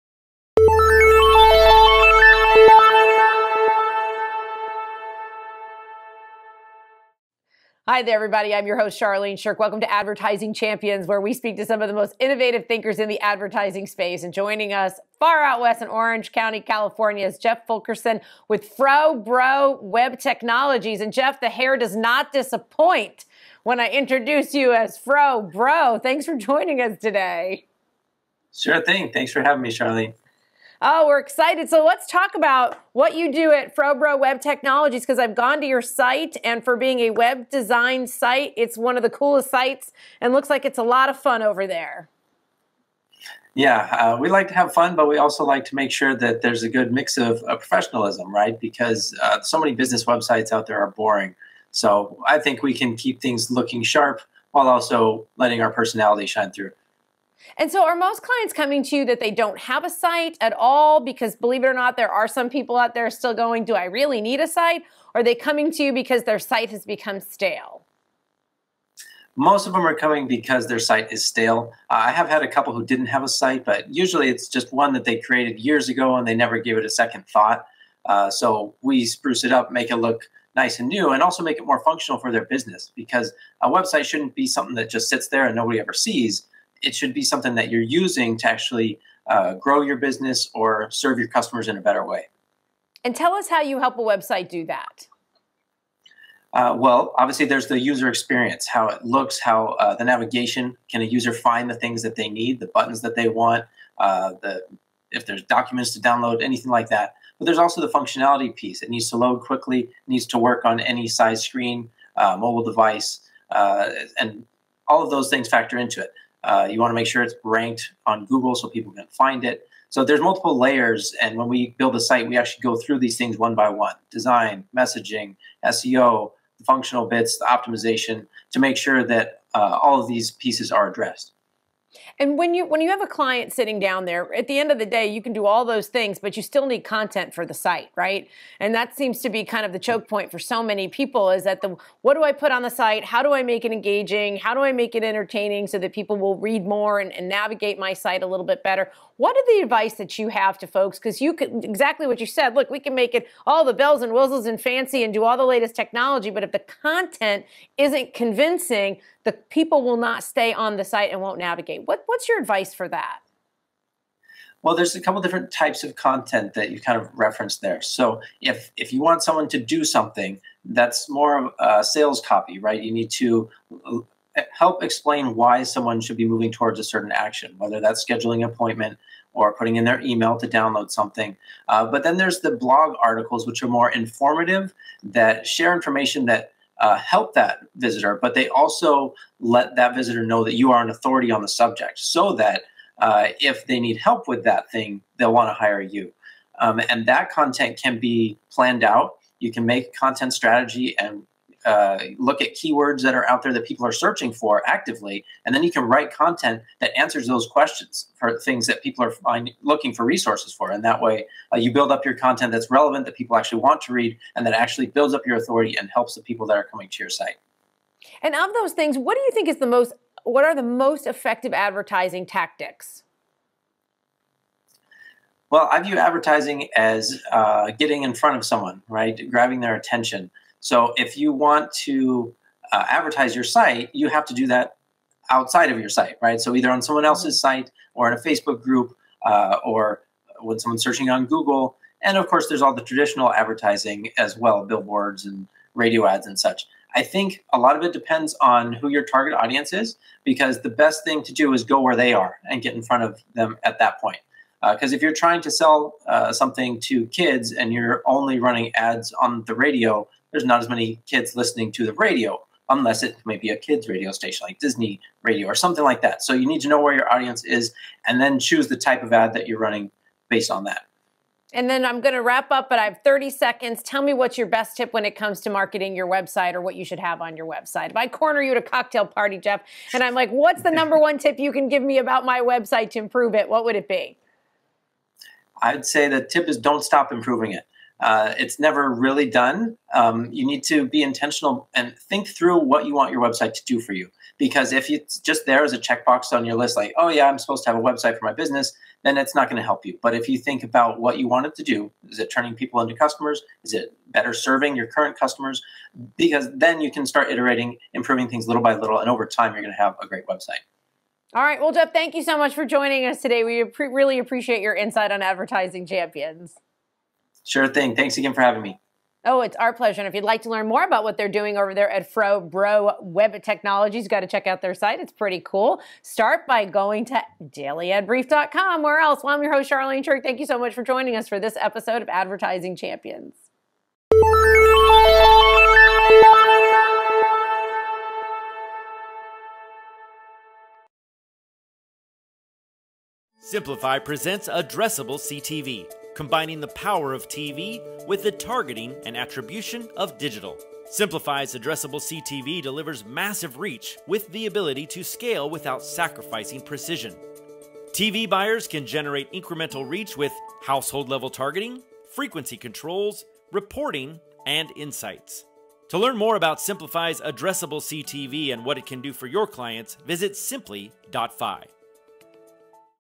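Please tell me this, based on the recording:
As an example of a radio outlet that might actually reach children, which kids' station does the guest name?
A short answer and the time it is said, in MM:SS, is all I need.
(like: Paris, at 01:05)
Disney Radio, at 04:24.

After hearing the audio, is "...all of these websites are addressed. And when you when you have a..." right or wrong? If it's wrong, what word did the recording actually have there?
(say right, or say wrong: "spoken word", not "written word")
wrong: "pieces", not "websites".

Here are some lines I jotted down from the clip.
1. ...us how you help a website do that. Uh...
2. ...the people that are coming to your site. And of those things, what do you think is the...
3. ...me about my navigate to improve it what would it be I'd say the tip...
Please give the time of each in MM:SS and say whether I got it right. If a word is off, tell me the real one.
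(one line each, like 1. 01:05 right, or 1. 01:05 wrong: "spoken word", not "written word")
1. 01:33 right
2. 03:36 right
3. 04:41 wrong: "website", not "navigate".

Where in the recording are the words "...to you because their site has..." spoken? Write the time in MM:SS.
01:05.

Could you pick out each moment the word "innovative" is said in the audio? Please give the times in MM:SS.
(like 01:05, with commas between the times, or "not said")
00:12.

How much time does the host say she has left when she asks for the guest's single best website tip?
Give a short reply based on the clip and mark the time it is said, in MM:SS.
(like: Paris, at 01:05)
30 seconds, at 04:33.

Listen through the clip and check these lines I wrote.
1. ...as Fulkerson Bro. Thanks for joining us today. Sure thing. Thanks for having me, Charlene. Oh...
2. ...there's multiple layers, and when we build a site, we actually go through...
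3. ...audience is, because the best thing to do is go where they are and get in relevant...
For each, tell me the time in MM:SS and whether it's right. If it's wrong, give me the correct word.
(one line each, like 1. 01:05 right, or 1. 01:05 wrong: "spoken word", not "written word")
1. 00:24 wrong: "Fro", not "Fulkerson"
2. 02:00 right
3. 04:09 wrong: "front", not "relevant".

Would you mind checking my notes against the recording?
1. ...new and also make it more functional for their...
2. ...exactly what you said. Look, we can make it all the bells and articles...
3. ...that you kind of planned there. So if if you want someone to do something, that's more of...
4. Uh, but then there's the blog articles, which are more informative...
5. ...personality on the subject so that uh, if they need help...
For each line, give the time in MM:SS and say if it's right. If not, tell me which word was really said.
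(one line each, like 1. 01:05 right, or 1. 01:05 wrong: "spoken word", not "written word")
1. 01:20 right
2. 02:31 wrong: "whistles", not "articles"
3. 02:46 wrong: "referenced", not "planned"
4. 03:01 right
5. 03:10 wrong: "authority", not "personality".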